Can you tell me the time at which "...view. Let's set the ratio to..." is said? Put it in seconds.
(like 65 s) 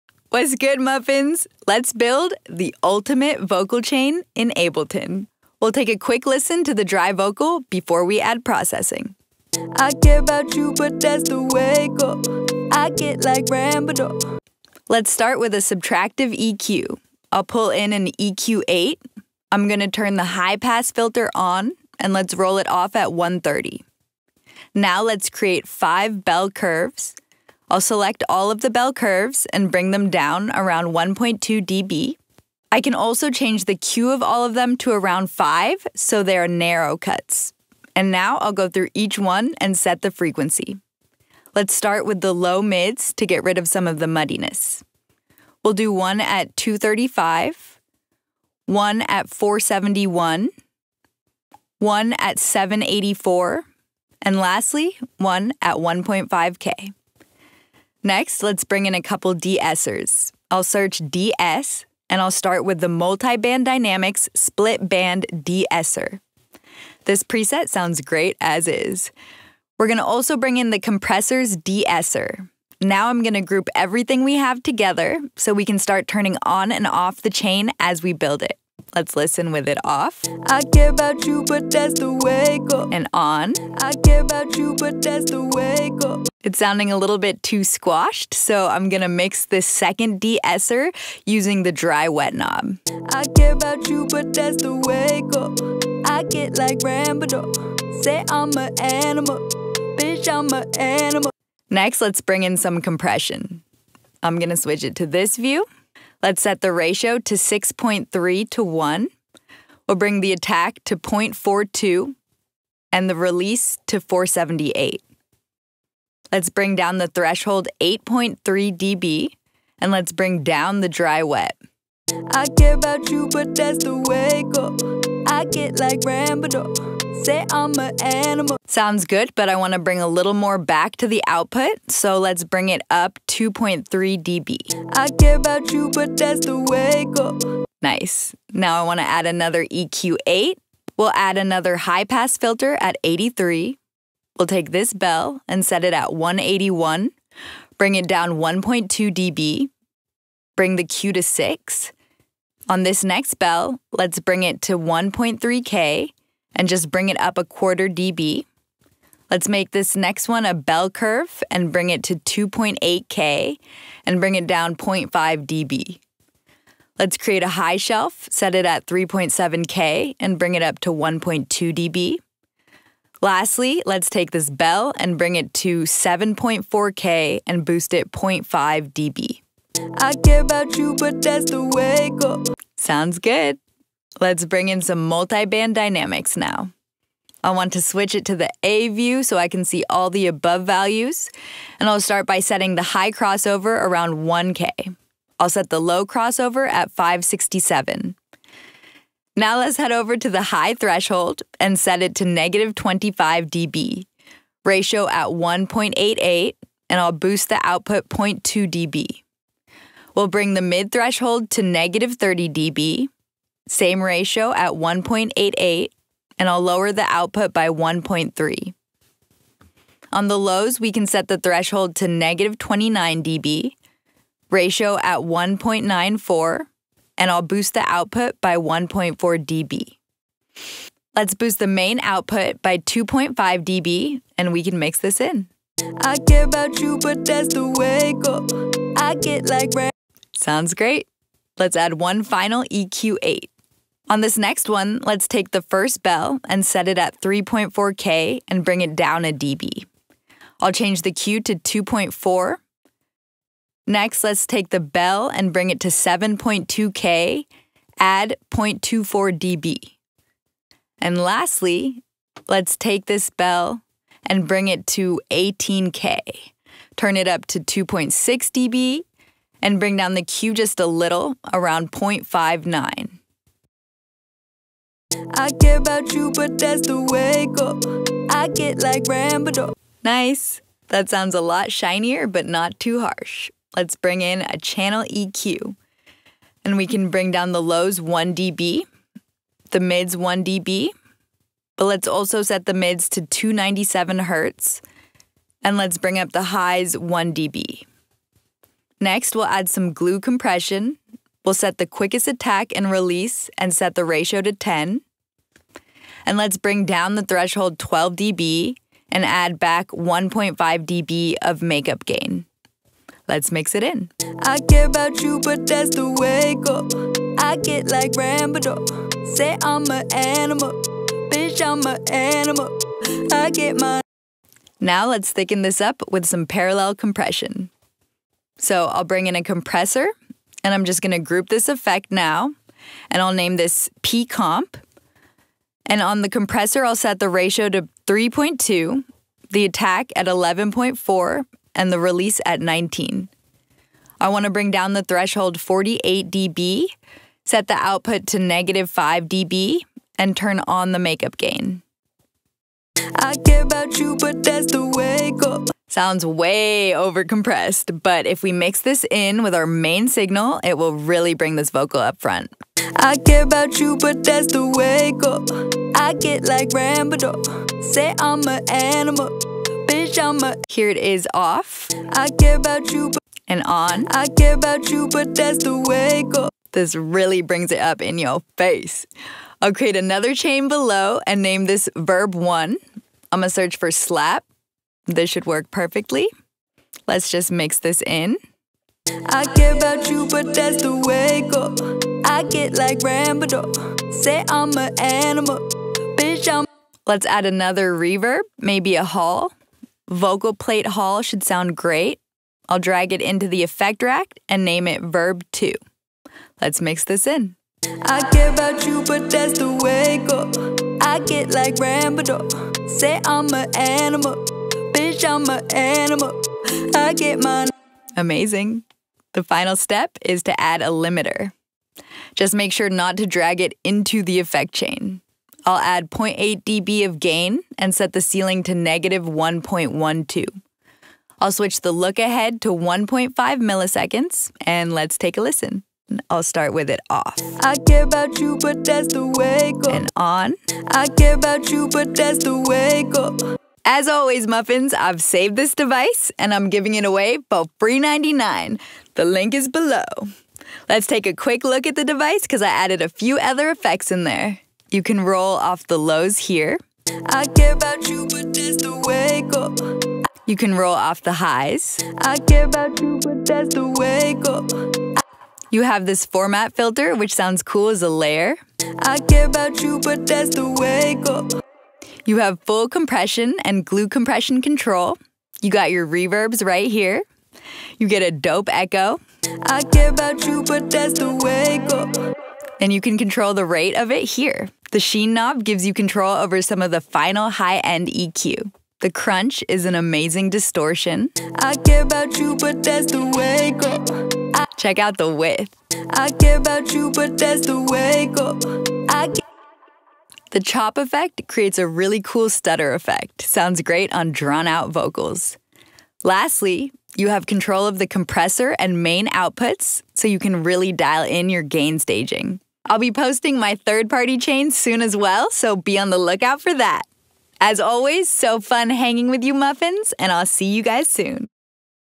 105 s.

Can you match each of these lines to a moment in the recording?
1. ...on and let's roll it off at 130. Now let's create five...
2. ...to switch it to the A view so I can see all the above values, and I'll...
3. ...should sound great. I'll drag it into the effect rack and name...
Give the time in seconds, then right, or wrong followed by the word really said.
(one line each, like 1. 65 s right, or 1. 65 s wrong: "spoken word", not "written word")
1. 21 s right
2. 187 s right
3. 401 s right.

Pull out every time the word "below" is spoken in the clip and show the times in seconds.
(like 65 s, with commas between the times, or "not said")
380 s, 449 s.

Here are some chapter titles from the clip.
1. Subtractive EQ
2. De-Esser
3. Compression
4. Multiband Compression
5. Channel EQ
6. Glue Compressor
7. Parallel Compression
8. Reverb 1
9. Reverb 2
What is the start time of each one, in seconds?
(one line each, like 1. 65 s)
1. 16 s
2. 60 s
3. 104 s
4. 185 s
5. 283 s
6. 300 s
7. 327 s
8. 379 s
9. 397 s.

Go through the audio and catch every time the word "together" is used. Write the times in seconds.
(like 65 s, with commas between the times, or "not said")
74 s.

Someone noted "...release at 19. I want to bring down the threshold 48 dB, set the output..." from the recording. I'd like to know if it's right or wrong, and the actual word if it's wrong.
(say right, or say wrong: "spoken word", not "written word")
right.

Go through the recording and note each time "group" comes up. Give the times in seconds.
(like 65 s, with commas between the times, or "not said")
73 s, 331 s.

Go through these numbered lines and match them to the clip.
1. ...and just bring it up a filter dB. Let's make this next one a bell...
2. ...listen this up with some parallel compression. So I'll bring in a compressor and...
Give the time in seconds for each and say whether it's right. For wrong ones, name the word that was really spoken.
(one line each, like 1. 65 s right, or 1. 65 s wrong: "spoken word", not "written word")
1. 156 s wrong: "quarter", not "filter"
2. 325 s wrong: "thicken", not "listen".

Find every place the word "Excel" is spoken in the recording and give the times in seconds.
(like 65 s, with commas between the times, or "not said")
not said.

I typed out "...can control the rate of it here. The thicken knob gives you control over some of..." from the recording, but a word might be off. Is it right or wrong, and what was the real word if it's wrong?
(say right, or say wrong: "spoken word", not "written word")
wrong: "sheen", not "thicken".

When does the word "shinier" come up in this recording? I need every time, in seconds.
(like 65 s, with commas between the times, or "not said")
281 s.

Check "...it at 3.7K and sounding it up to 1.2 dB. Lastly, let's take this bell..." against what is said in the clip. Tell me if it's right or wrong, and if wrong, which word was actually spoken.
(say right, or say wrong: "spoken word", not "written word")
wrong: "bring", not "sounding".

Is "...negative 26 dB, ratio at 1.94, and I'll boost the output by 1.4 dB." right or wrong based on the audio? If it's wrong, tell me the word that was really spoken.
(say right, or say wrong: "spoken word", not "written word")
wrong: "29", not "26".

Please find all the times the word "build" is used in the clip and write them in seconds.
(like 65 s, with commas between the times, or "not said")
1 s, 78 s.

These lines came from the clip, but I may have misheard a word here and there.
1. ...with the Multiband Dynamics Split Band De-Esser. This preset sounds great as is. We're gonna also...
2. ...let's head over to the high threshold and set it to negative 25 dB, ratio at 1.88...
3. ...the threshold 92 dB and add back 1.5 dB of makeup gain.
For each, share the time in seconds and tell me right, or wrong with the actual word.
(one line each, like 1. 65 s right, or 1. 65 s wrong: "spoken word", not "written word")
1. 62 s right
2. 199 s right
3. 307 s wrong: "12", not "92".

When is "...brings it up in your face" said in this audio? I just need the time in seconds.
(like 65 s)
377 s.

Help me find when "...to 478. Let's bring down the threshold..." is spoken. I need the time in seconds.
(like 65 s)
113 s.